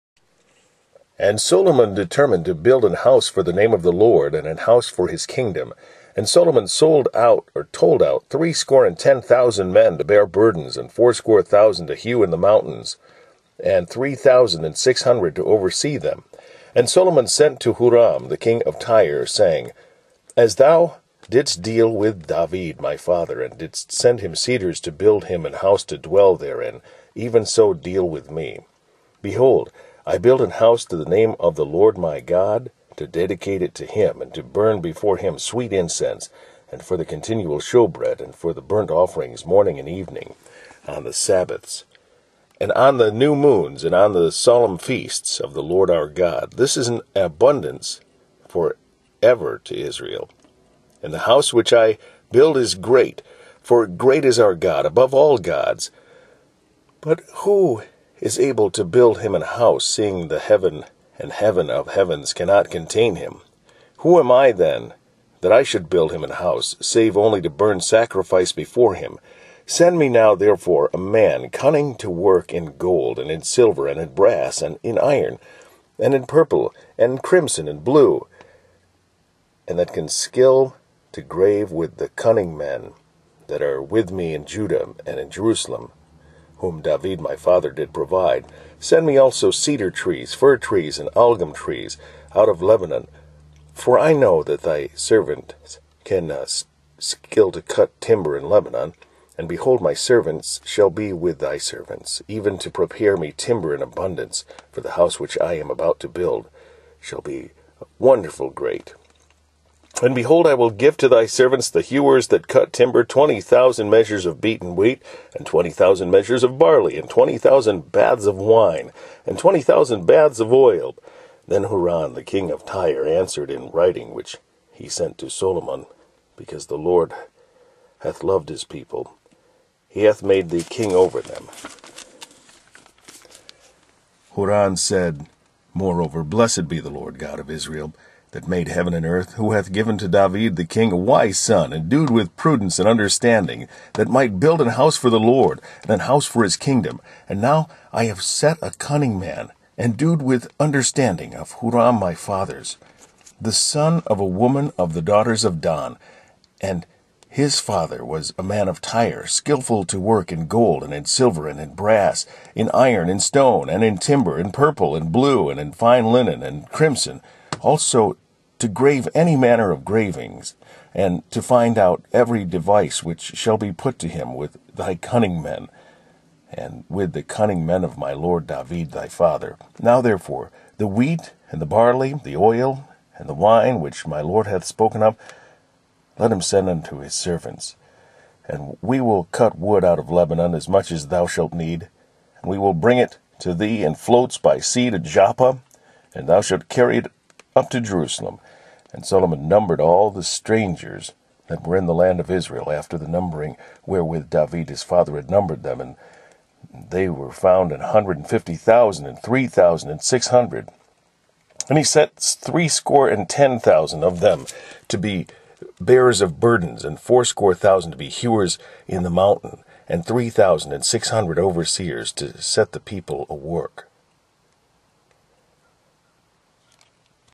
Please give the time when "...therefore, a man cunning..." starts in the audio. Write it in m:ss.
1:10.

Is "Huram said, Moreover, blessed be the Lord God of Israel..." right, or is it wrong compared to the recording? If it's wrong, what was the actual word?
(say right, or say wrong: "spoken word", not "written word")
right.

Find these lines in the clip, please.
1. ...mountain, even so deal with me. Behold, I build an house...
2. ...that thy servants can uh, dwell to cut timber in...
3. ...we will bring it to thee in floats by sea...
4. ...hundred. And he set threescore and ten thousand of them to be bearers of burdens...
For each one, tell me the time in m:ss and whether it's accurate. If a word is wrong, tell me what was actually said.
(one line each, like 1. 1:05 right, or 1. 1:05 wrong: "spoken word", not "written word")
1. 0:26 wrong: "therein", not "mountain"
2. 1:34 wrong: "skill", not "dwell"
3. 3:12 right
4. 3:30 right.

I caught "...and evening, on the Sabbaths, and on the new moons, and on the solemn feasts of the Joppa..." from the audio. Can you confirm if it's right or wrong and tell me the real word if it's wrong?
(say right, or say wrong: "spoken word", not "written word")
wrong: "Lord", not "Joppa".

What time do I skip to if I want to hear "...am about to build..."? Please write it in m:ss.
1:45.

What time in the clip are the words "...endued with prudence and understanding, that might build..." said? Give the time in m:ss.
2:21.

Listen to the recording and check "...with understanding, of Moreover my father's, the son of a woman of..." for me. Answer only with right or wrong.
wrong.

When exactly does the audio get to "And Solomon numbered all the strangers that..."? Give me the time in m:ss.
3:18.